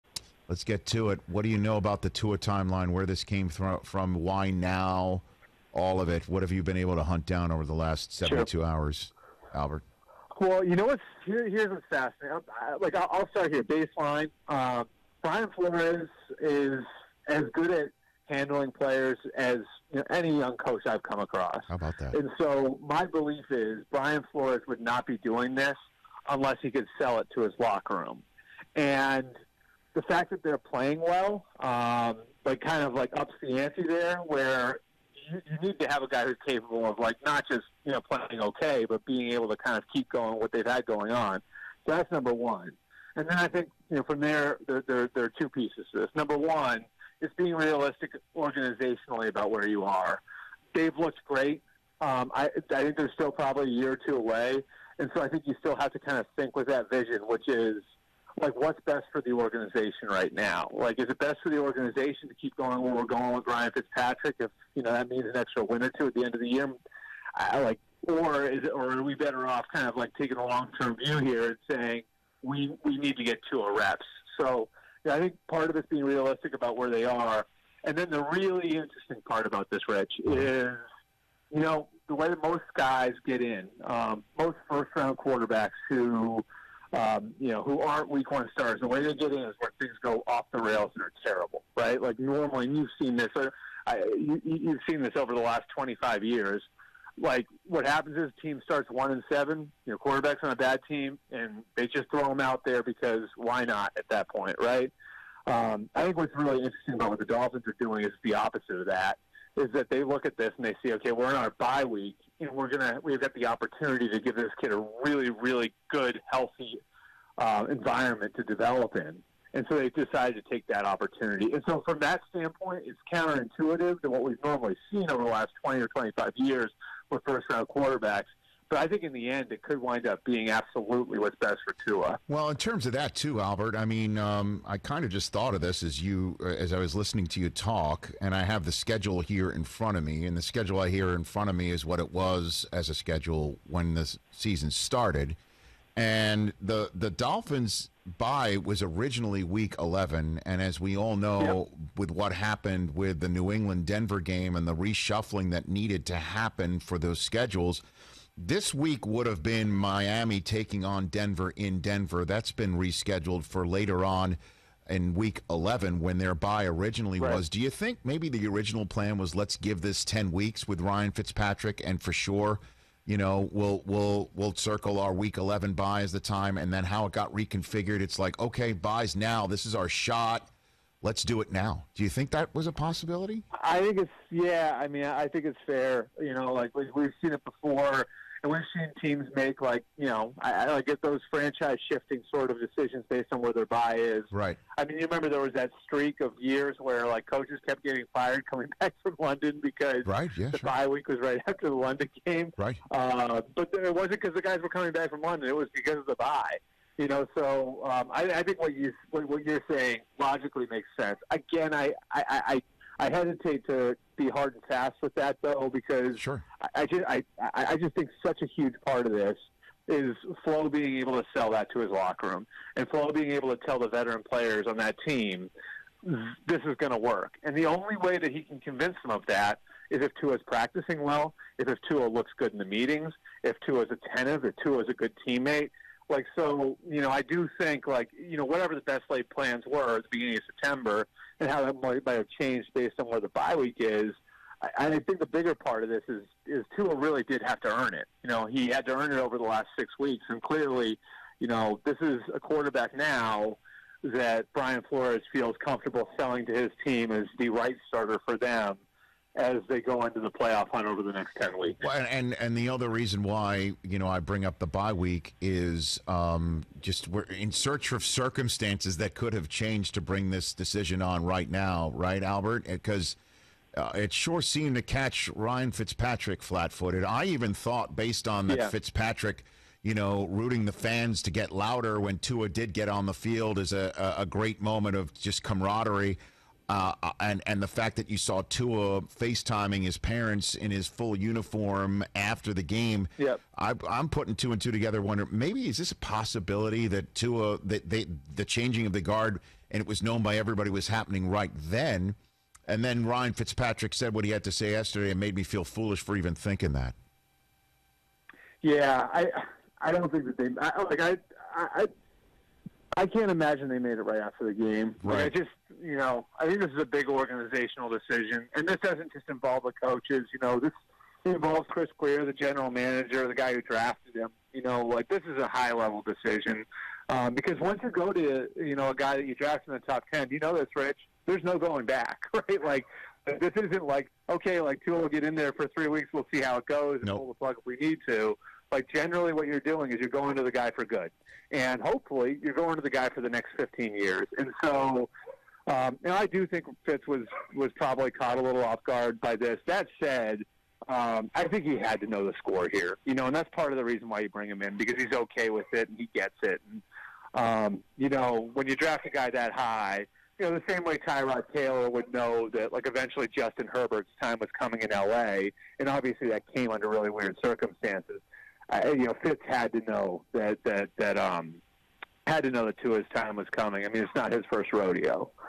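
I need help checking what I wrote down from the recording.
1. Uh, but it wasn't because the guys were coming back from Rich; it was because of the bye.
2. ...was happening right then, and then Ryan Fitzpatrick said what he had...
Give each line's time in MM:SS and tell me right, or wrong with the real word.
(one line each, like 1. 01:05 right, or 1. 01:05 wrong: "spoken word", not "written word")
1. 03:22 wrong: "London", not "Rich"
2. 05:00 right.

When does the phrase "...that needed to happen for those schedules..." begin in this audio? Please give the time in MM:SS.
02:35.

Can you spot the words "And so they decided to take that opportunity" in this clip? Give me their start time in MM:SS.
01:59.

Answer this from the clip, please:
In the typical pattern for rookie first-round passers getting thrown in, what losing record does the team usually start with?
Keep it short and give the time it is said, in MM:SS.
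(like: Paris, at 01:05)
1-7, at 01:38.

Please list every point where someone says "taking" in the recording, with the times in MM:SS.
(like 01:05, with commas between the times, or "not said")
01:10, 02:40.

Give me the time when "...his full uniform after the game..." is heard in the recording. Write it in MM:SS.
04:50.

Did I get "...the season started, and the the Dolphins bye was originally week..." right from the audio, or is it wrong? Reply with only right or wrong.
right.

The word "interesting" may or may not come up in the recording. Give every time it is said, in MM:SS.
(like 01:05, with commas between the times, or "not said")
01:18, 01:46.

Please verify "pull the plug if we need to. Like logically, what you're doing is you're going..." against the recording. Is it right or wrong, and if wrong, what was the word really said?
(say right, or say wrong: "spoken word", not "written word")
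wrong: "generally", not "logically".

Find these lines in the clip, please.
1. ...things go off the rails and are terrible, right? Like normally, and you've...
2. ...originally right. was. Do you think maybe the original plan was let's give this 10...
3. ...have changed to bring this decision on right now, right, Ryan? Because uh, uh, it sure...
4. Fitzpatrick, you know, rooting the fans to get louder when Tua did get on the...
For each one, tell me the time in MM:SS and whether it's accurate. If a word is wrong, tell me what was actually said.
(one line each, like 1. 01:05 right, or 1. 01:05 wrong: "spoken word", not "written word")
1. 01:29 right
2. 02:46 right
3. 04:29 wrong: "Albert", not "Ryan"
4. 04:38 right.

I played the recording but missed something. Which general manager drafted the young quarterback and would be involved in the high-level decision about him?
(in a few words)
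Chris Grier.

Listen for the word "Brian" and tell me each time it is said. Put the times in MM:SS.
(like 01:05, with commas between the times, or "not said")
00:15, 00:23, 04:14.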